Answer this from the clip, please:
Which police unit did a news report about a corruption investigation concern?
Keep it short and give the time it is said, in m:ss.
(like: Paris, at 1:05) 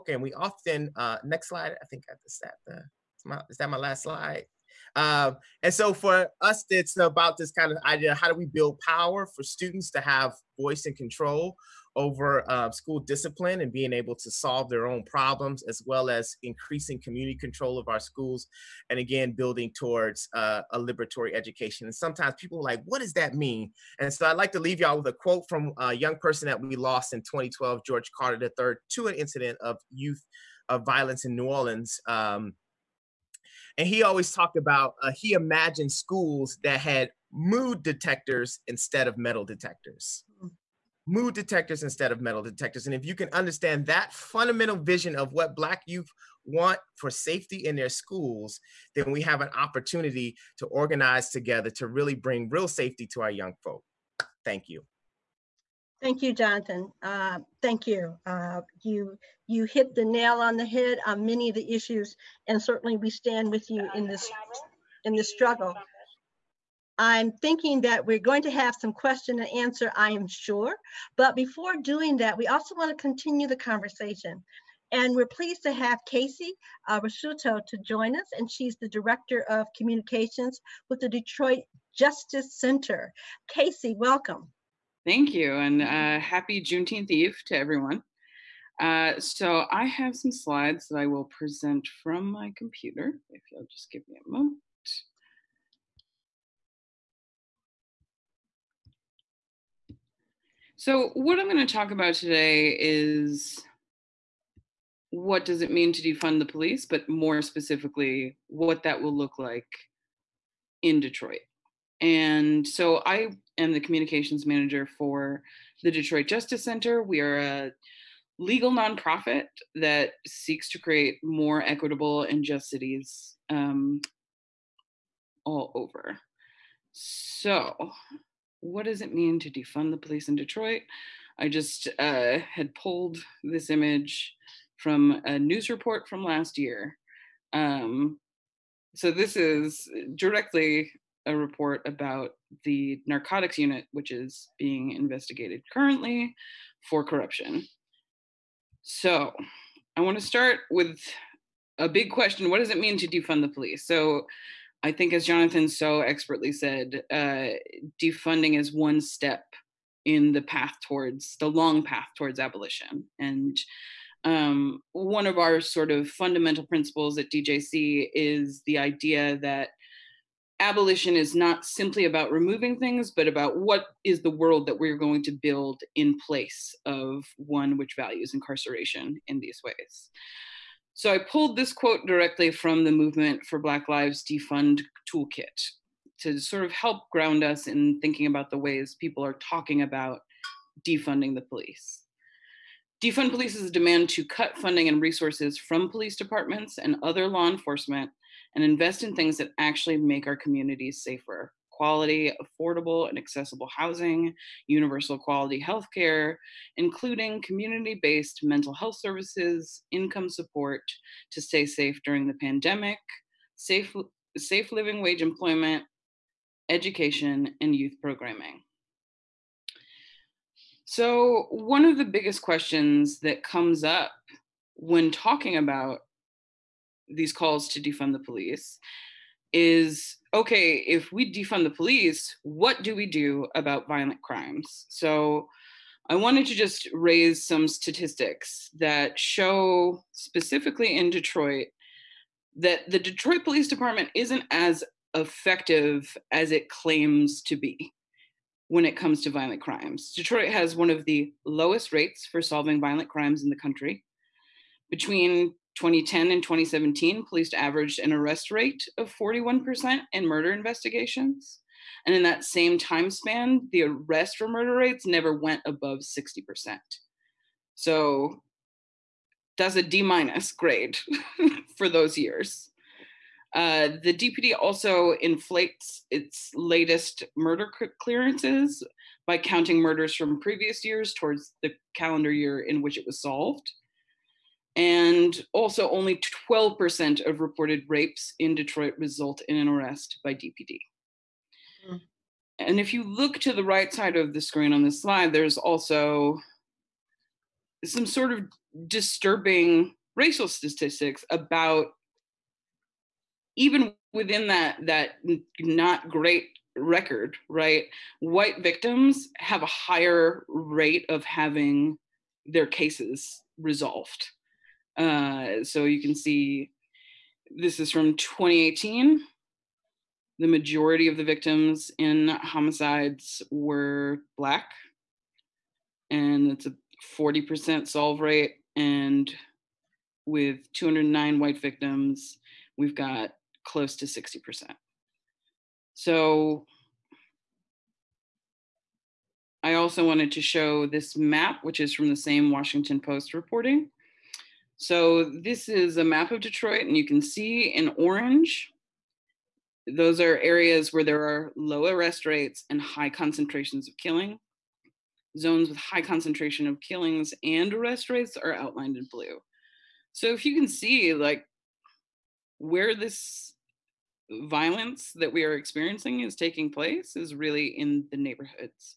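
narcotics unit, at 2:23.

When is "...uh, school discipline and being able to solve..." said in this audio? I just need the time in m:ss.
0:12.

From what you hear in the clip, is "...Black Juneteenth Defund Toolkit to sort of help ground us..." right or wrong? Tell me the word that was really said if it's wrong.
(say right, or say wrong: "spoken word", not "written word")
wrong: "Lives", not "Juneteenth".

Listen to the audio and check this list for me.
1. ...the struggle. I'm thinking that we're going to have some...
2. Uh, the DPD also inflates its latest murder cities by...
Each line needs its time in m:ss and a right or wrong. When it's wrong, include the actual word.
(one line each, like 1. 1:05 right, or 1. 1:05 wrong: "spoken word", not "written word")
1. 1:05 right
2. 4:33 wrong: "clearances", not "cities".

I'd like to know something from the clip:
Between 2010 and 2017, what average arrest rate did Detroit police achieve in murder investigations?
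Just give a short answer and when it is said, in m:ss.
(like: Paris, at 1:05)
41%, at 4:19.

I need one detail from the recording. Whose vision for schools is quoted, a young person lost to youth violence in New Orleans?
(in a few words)
George Carter III.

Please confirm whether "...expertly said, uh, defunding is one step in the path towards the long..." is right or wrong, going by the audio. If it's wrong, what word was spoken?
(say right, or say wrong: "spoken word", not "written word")
right.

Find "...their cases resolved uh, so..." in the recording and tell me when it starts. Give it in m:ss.
5:12.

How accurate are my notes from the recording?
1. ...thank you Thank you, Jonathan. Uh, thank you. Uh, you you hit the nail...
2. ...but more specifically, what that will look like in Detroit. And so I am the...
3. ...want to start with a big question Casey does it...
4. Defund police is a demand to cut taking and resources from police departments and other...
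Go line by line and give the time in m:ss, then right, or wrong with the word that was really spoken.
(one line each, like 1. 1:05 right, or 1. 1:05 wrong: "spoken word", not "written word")
1. 0:54 right
2. 1:46 right
3. 2:30 wrong: "What", not "Casey"
4. 3:13 wrong: "funding", not "taking".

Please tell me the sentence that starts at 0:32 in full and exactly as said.
Um, and he always talked about uh, he imagined schools that had mood detectors instead of metal detectors mm-hmm.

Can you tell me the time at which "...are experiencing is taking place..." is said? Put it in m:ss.
6:05.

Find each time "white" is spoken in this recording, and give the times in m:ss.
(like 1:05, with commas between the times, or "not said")
5:08, 5:31.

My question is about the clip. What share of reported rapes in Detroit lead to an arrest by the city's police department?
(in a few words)
12%.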